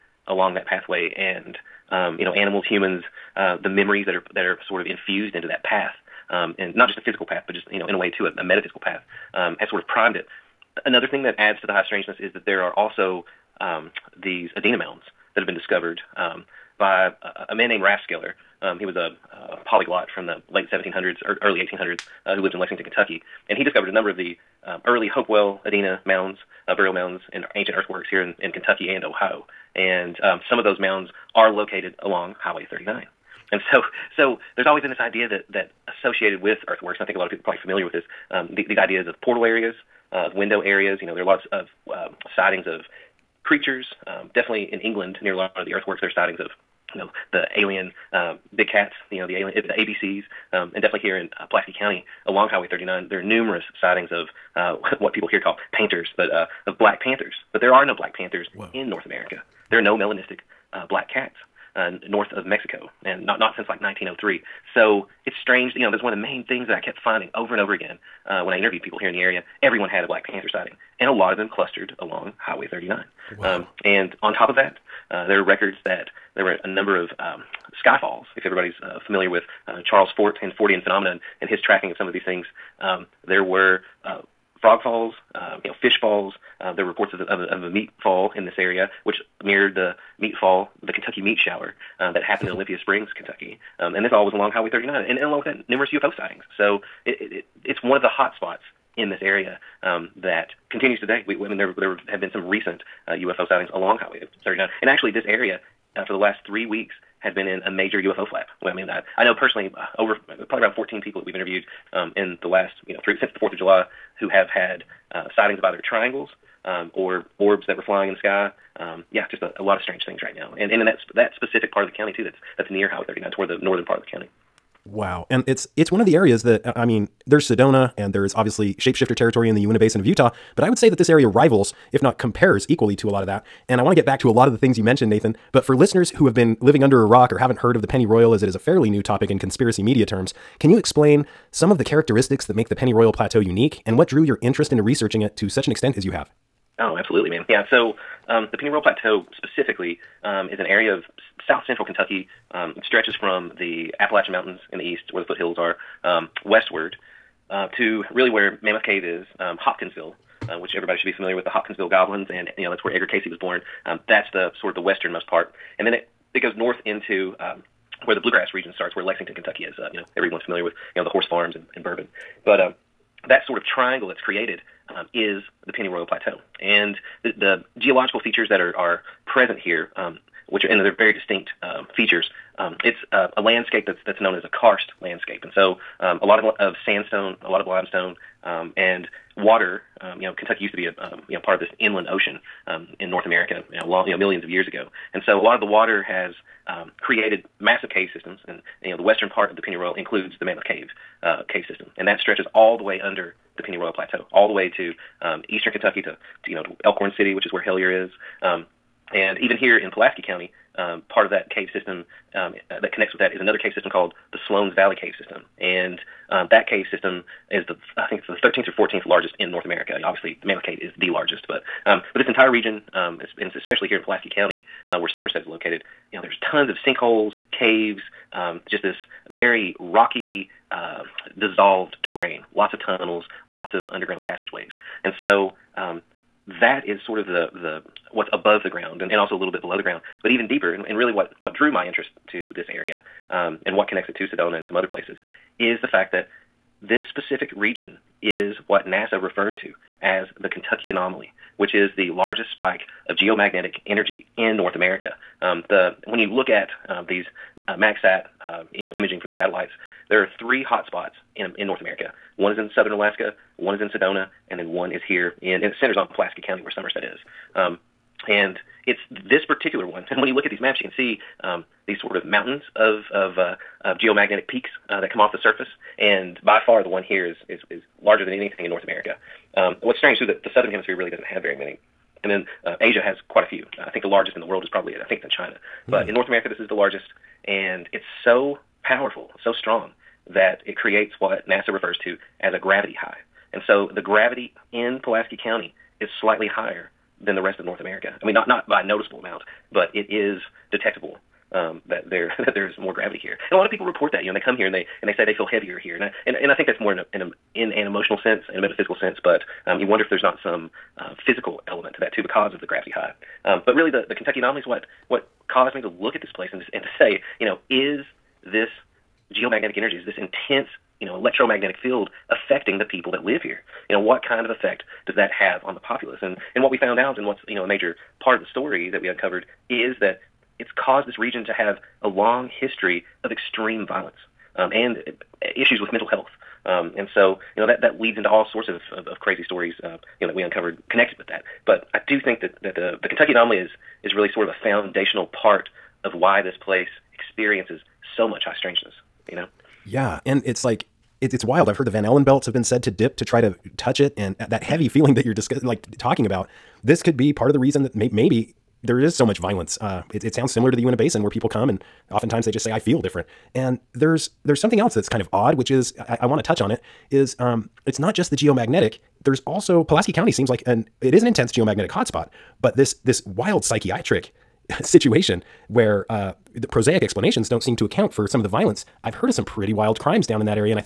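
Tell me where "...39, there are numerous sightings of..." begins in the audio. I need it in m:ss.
0:52.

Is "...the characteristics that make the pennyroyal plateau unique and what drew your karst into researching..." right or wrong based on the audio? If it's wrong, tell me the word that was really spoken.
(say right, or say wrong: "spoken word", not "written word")
wrong: "interest", not "karst".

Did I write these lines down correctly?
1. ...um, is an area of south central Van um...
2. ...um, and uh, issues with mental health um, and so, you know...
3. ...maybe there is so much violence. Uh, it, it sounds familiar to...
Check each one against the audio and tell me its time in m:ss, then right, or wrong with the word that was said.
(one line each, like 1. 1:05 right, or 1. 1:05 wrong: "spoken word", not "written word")
1. 2:30 wrong: "Kentucky", not "Van"
2. 5:34 right
3. 5:58 wrong: "similar", not "familiar".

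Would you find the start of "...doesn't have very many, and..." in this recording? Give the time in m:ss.
4:41.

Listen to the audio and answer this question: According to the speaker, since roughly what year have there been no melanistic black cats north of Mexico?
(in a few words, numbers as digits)
1903.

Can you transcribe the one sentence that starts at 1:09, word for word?
Everyone had a Black Panther sighting, and a lot of them clustered along Highway 39.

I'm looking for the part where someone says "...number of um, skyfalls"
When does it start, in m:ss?
1:16.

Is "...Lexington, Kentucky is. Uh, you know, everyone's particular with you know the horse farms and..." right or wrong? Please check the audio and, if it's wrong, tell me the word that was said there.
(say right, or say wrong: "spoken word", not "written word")
wrong: "familiar", not "particular".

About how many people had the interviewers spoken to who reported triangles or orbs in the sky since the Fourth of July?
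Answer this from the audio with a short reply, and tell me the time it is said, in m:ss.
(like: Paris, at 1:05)
14, at 1:50.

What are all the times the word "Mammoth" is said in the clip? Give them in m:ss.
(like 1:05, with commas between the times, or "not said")
2:38, 3:20, 3:40.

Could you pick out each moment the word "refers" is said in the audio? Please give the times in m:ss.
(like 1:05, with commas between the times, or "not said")
4:09, 4:51.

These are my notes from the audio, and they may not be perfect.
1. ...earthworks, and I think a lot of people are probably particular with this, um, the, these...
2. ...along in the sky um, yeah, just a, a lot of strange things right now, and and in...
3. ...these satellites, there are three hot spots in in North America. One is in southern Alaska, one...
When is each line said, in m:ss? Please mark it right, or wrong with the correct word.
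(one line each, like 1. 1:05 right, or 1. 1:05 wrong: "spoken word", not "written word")
1. 0:36 wrong: "familiar", not "particular"
2. 1:57 wrong: "flying", not "along"
3. 4:19 right.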